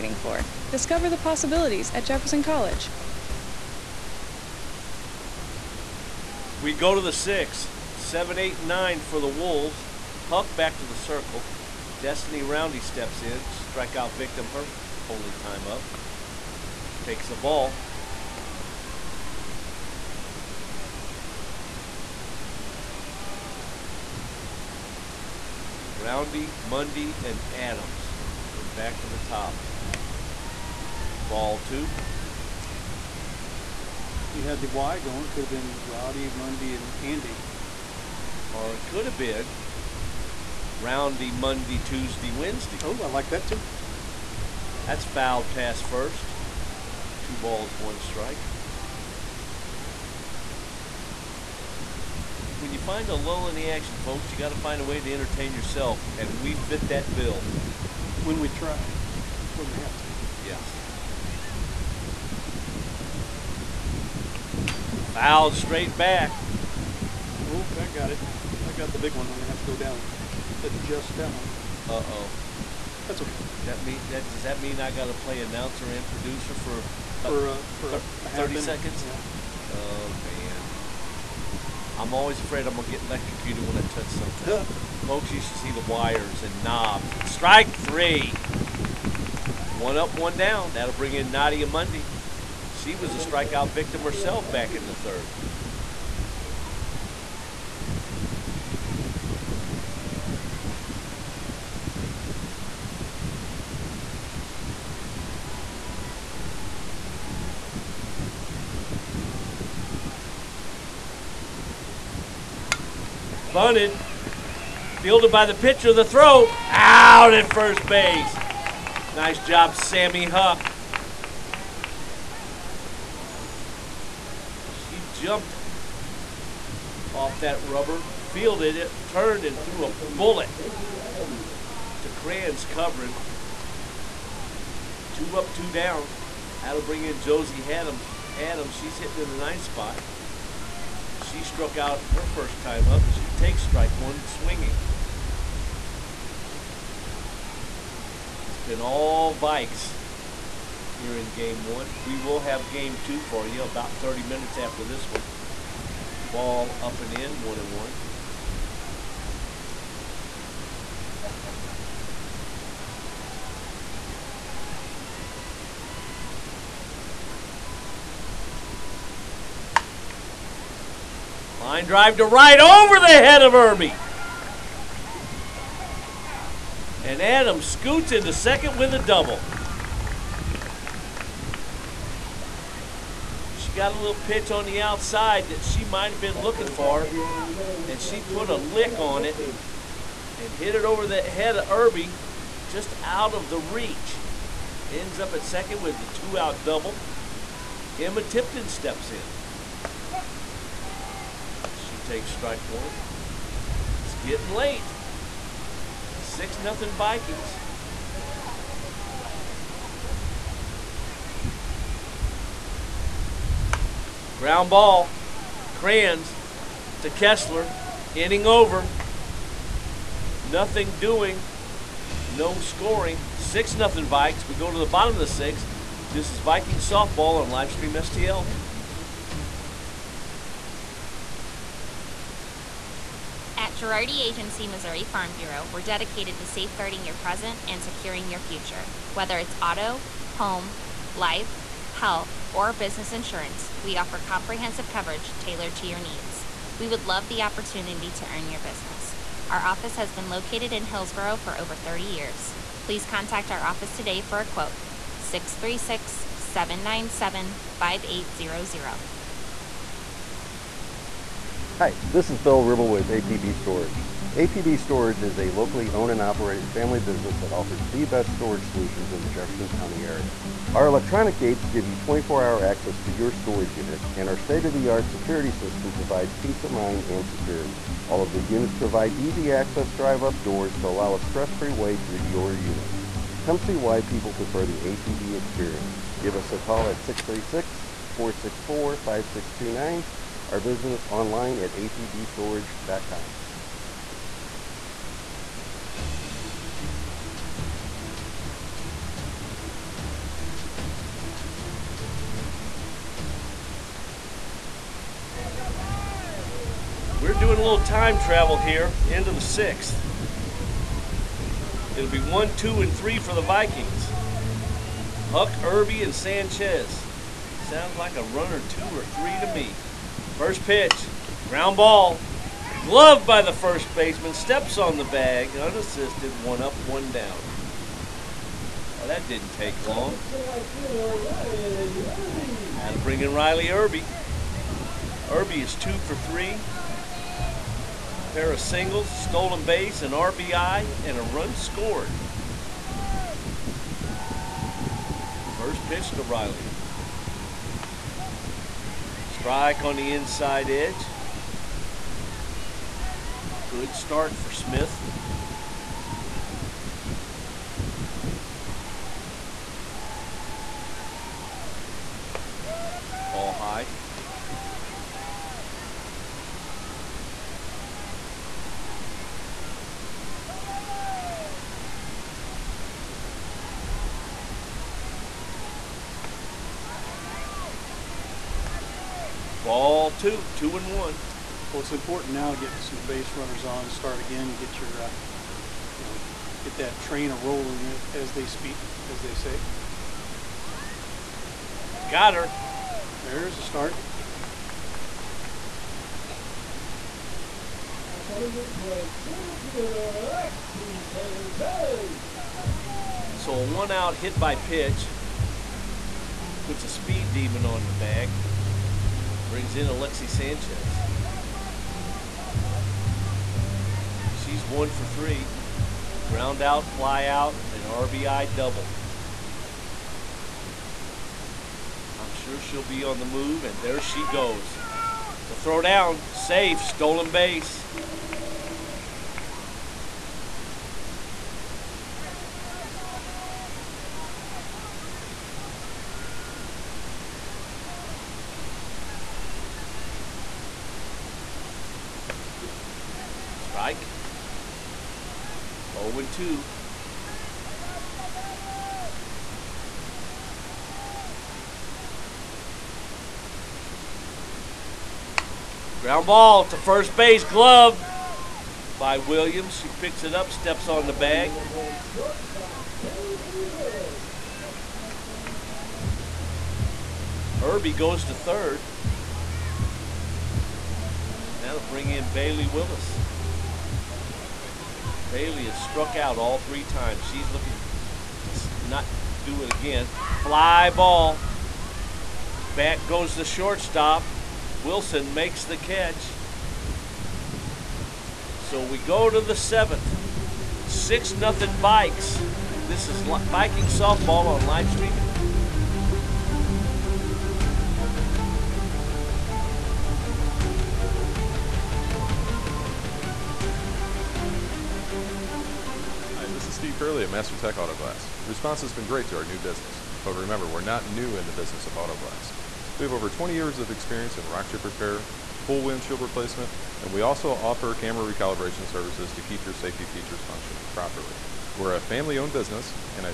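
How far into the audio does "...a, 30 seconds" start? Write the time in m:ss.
1:18.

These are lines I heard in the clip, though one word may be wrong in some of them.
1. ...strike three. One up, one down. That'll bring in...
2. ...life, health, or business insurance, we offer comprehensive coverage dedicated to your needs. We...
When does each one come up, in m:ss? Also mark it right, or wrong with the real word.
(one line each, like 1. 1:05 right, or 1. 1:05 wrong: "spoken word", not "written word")
1. 1:27 right
2. 4:01 wrong: "tailored", not "dedicated".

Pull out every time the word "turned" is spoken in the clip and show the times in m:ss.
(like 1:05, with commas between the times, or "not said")
2:09.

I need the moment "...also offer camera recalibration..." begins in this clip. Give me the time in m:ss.
8:37.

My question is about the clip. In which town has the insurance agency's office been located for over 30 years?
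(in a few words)
Hillsboro.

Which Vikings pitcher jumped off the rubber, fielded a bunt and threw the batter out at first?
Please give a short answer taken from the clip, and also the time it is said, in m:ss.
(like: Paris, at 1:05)
Sammy Huck, at 1:59.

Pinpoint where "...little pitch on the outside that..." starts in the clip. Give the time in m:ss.
3:03.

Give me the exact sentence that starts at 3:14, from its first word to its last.
Ends up at second with the two out double.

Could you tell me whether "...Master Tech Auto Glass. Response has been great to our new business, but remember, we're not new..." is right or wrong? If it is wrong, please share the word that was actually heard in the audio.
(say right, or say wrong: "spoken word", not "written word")
right.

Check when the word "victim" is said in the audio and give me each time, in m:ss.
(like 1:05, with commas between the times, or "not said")
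0:14, 1:33.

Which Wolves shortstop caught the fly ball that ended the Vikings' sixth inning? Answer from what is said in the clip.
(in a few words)
Wilson.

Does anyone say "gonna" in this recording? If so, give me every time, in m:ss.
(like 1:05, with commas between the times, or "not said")
1:09, 1:22.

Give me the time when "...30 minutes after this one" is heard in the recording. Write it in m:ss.
2:33.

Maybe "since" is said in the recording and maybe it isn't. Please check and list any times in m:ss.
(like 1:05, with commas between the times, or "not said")
not said.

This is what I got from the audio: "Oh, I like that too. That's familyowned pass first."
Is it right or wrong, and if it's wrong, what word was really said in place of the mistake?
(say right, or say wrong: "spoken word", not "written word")
wrong: "fouled", not "familyowned".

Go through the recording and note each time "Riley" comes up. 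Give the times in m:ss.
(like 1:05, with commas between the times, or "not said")
5:33, 5:46.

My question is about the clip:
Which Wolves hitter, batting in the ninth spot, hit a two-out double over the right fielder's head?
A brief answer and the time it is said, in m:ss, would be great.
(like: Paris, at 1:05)
Josie Adams, at 2:17.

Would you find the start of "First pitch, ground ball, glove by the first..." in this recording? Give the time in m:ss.
5:20.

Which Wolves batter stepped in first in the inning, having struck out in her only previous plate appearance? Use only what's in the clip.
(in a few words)
Destiny Roundy.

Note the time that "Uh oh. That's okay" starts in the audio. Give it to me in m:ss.
1:11.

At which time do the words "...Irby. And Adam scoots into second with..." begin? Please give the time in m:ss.
2:53.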